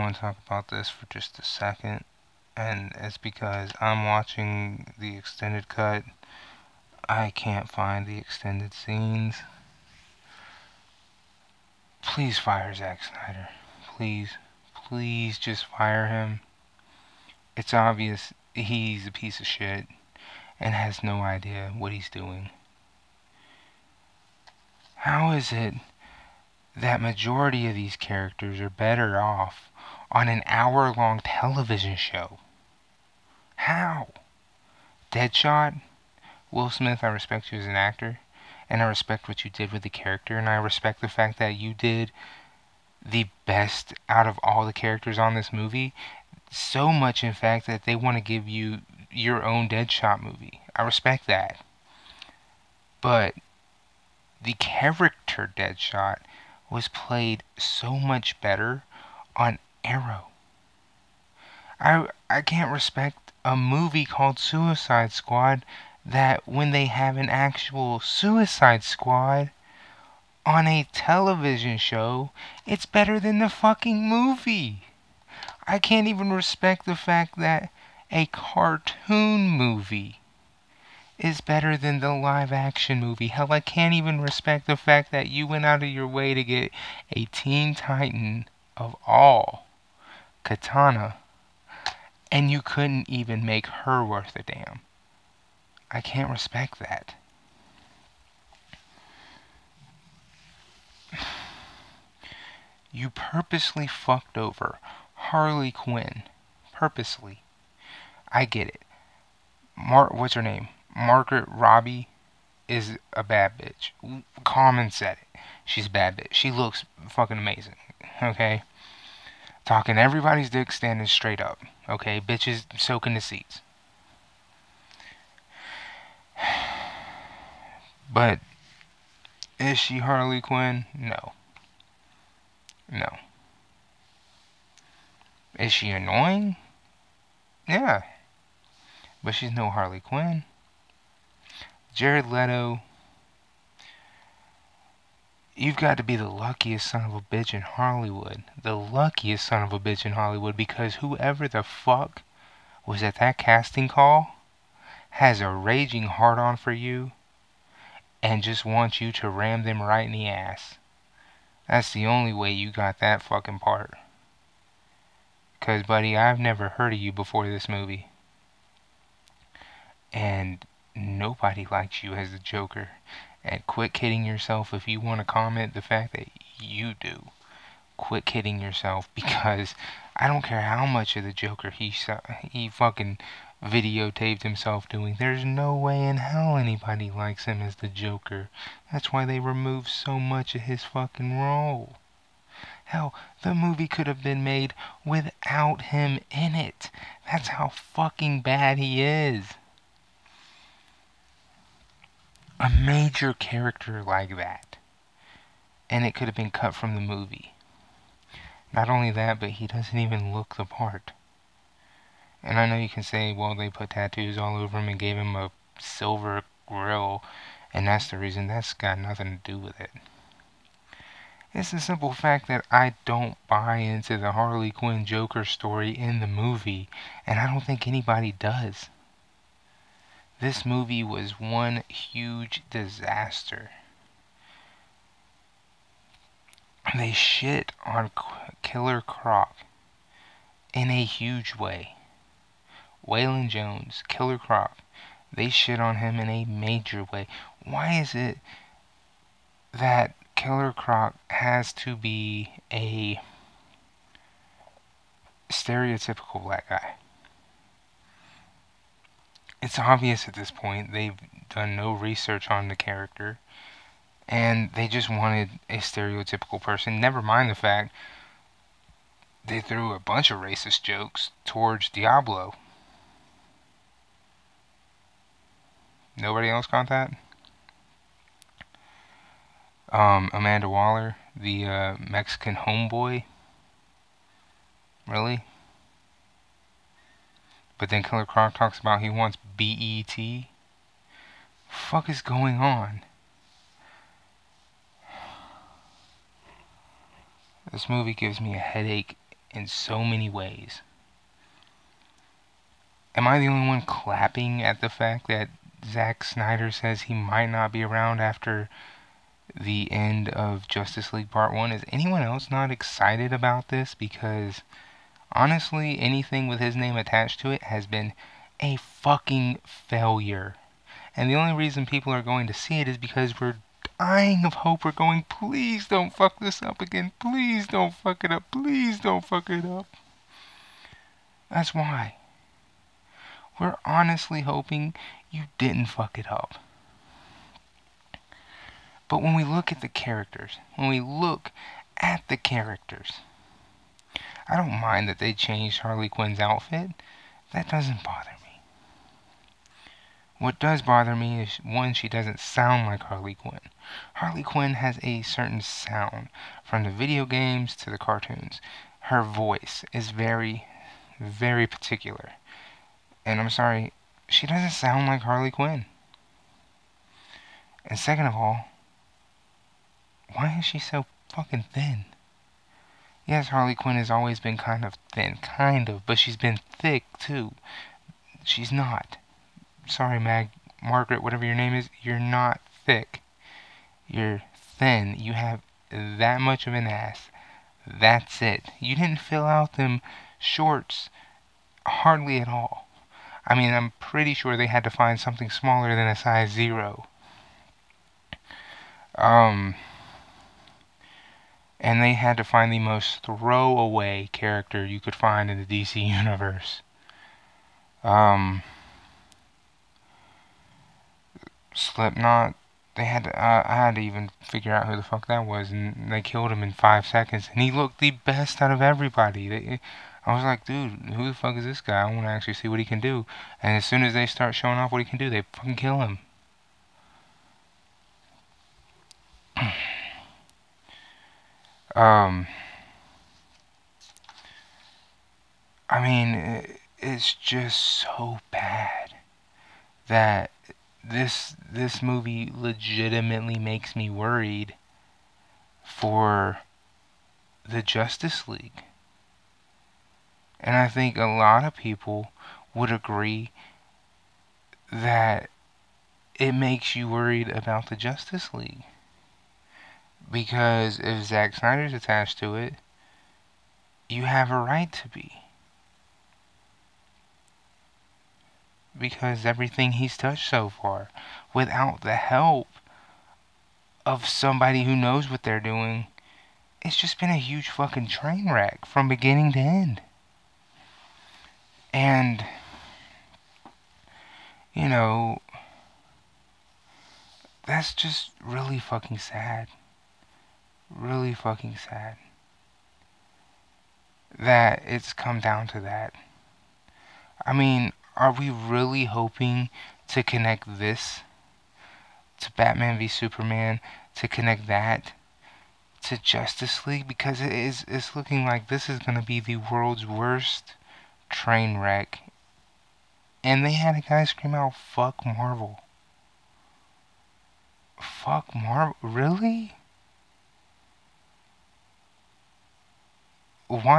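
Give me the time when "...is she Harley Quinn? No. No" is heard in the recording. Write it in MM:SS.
02:09.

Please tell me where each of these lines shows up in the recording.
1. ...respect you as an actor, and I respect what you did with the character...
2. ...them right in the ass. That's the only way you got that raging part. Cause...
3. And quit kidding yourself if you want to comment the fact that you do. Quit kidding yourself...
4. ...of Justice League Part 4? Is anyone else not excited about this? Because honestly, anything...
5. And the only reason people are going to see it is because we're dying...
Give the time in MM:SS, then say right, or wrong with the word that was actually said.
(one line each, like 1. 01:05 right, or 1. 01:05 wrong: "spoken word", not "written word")
1. 00:37 right
2. 02:39 wrong: "fucking", not "raging"
3. 02:53 right
4. 05:10 wrong: "1", not "4"
5. 05:21 right.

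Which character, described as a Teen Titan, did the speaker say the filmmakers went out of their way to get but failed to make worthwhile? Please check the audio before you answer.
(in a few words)
Katana.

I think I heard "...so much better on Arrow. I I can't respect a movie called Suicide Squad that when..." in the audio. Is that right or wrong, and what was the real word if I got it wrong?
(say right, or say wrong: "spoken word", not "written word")
right.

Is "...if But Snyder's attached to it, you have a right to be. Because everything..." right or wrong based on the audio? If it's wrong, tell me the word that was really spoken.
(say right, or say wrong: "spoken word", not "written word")
wrong: "Zack", not "But".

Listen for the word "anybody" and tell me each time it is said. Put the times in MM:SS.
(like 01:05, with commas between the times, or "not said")
03:06, 03:47.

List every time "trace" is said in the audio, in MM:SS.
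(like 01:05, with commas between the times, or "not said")
not said.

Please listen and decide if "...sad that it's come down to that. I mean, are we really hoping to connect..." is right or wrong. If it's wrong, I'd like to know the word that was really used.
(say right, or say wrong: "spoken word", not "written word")
right.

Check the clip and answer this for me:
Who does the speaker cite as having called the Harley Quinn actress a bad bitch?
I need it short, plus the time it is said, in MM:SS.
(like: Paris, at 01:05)
Common, at 01:54.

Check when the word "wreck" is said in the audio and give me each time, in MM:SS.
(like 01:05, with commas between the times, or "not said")
07:58, 08:31.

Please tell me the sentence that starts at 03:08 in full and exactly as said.
That's why they removed so much of his fucking role.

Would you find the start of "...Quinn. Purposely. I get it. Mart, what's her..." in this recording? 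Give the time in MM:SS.
01:45.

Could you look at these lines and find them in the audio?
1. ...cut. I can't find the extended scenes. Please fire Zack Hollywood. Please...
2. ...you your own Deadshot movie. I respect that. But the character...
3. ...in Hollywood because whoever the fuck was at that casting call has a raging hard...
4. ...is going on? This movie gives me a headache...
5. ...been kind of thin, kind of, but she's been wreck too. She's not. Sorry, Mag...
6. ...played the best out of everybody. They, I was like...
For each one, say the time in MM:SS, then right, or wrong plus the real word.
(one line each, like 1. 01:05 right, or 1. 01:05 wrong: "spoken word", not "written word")
1. 00:05 wrong: "Snyder", not "Hollywood"
2. 00:48 right
3. 02:30 right
4. 04:52 right
5. 06:14 wrong: "thick", not "wreck"
6. 06:57 wrong: "looked", not "played".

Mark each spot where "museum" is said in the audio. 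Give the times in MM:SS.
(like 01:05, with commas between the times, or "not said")
not said.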